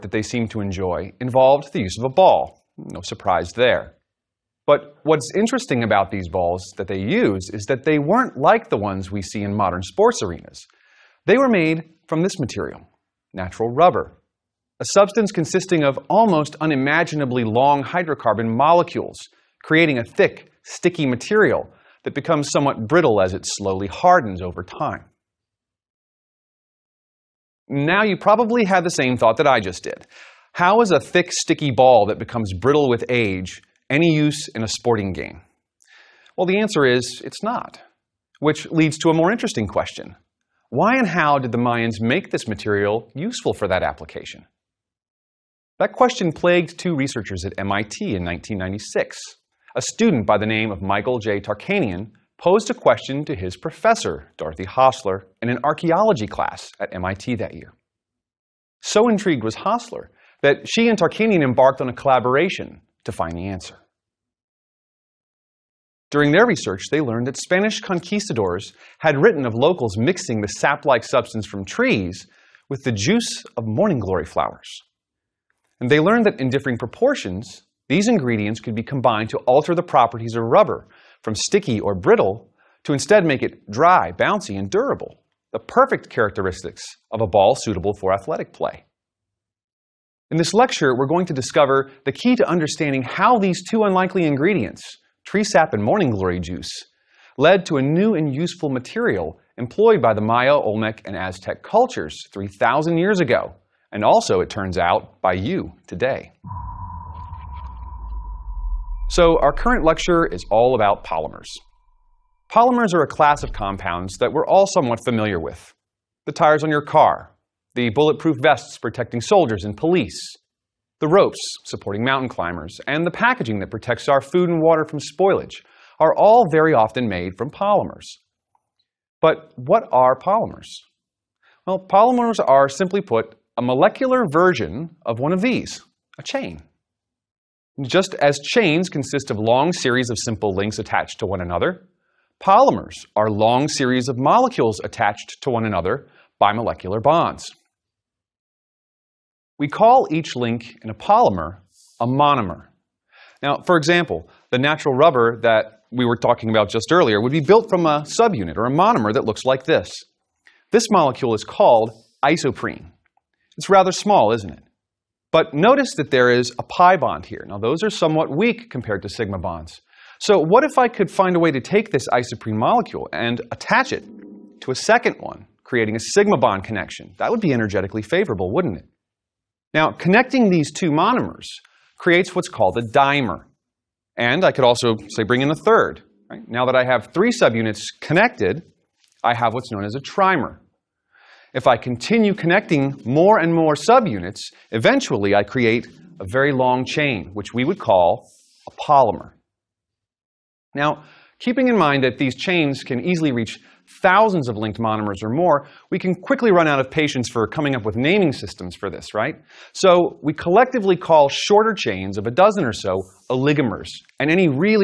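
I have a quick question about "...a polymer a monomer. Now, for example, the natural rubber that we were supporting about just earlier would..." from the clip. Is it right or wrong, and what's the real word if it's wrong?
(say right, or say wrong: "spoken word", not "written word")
wrong: "talking", not "supporting".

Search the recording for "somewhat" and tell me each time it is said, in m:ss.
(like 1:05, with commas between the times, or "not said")
0:22, 1:54, 2:47.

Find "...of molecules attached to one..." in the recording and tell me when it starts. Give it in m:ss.
2:24.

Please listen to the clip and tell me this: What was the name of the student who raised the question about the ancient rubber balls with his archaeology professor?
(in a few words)
Michael J. Tarkanian.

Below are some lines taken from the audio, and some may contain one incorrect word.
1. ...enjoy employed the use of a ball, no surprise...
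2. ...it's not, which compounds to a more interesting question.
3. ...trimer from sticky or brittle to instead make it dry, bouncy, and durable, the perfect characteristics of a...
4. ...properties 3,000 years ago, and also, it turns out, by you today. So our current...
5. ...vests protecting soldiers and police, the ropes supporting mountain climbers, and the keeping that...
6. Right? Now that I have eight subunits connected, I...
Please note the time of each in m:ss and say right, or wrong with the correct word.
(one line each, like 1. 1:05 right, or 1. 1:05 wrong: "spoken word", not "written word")
1. 0:00 wrong: "involved", not "employed"
2. 0:37 wrong: "leads", not "compounds"
3. 1:20 wrong: "rubber", not "trimer"
4. 1:41 wrong: "cultures", not "properties"
5. 1:58 wrong: "packaging", not "keeping"
6. 3:06 wrong: "three", not "eight".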